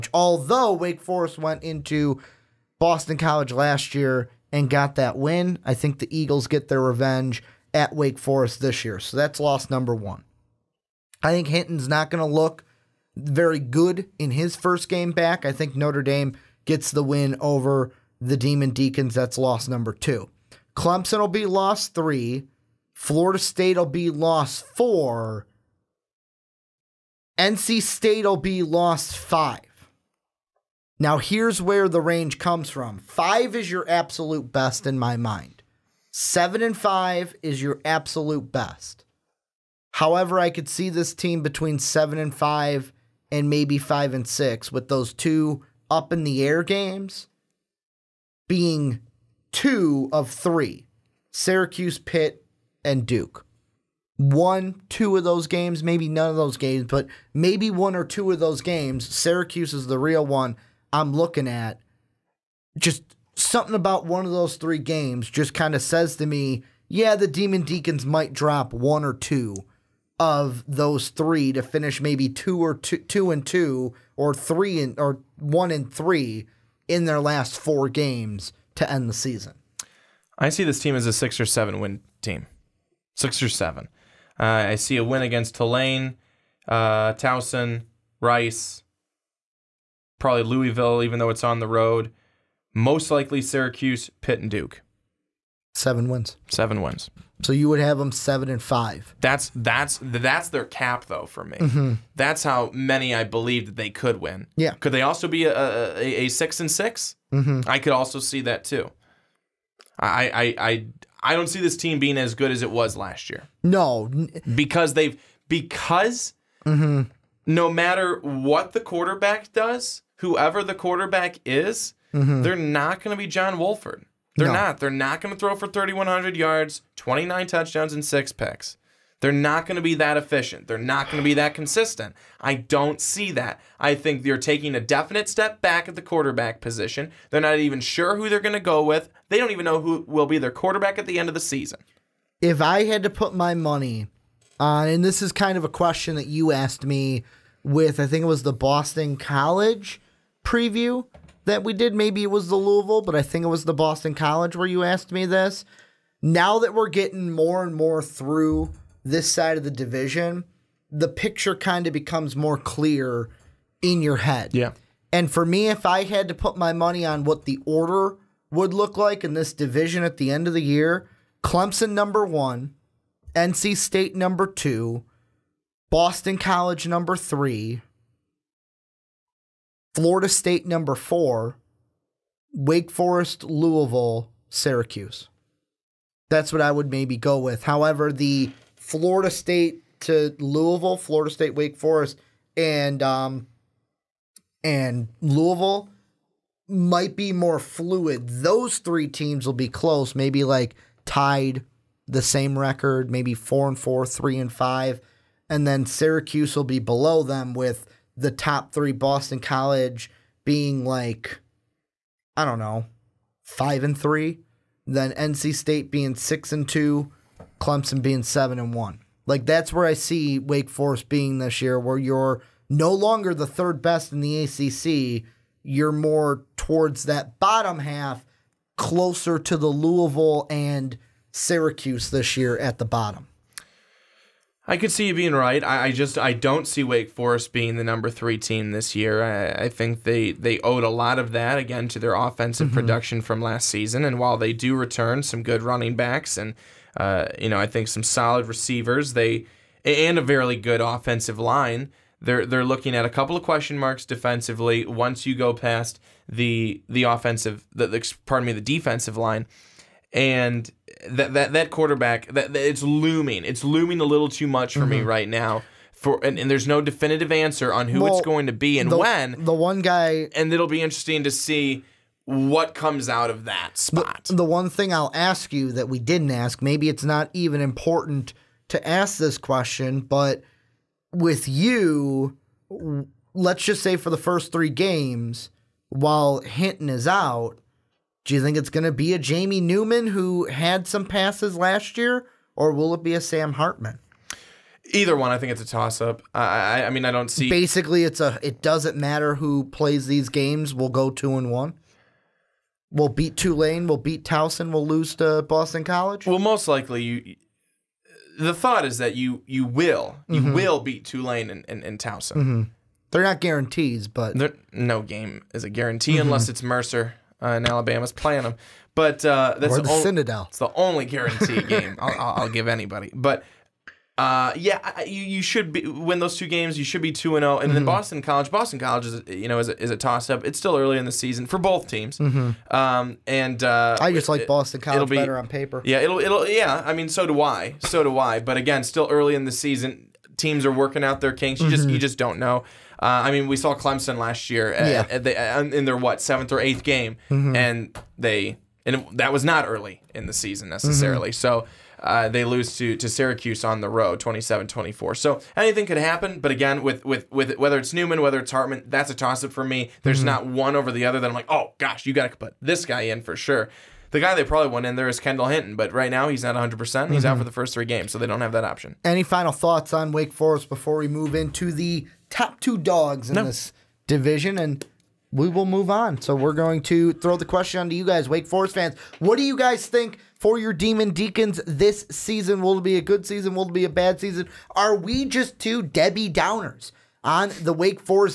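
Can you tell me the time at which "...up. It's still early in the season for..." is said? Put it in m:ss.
5:30.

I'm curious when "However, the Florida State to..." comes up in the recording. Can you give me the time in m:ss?
3:07.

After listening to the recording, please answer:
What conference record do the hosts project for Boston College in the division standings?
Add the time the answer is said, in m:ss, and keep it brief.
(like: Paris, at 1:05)
5-3, at 3:33.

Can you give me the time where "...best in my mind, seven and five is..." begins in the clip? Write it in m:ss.
0:34.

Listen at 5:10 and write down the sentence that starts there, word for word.
will beat Tulane and and, and Towson.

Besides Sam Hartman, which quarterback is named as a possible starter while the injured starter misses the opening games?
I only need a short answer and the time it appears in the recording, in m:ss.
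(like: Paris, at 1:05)
Jamie Newman, at 4:49.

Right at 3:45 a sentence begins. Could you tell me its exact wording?
You're more towards that bottom half, closer to the Louisville and Syracuse this year at the bottom.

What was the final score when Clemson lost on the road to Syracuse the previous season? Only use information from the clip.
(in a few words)
27-24.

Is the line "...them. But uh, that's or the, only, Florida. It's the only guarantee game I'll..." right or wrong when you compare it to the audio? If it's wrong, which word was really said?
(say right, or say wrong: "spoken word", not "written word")
wrong: "Citadel", not "Florida".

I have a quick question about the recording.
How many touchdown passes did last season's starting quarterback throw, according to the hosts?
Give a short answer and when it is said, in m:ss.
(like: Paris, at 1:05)
29, at 2:06.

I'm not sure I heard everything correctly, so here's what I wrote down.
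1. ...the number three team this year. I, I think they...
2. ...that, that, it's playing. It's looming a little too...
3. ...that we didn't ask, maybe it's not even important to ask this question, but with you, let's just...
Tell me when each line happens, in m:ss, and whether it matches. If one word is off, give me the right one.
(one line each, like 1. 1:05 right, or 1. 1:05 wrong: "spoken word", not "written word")
1. 3:57 right
2. 4:22 wrong: "looming", not "playing"
3. 4:35 right.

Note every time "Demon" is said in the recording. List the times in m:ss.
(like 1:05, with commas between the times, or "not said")
0:18, 1:07, 6:20.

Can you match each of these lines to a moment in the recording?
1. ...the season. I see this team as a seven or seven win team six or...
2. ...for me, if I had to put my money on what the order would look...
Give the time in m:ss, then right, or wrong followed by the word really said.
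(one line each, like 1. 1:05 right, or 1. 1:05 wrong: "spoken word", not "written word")
1. 1:19 wrong: "six", not "seven"
2. 2:45 right.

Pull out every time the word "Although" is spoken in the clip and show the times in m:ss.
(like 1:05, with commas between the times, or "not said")
0:00.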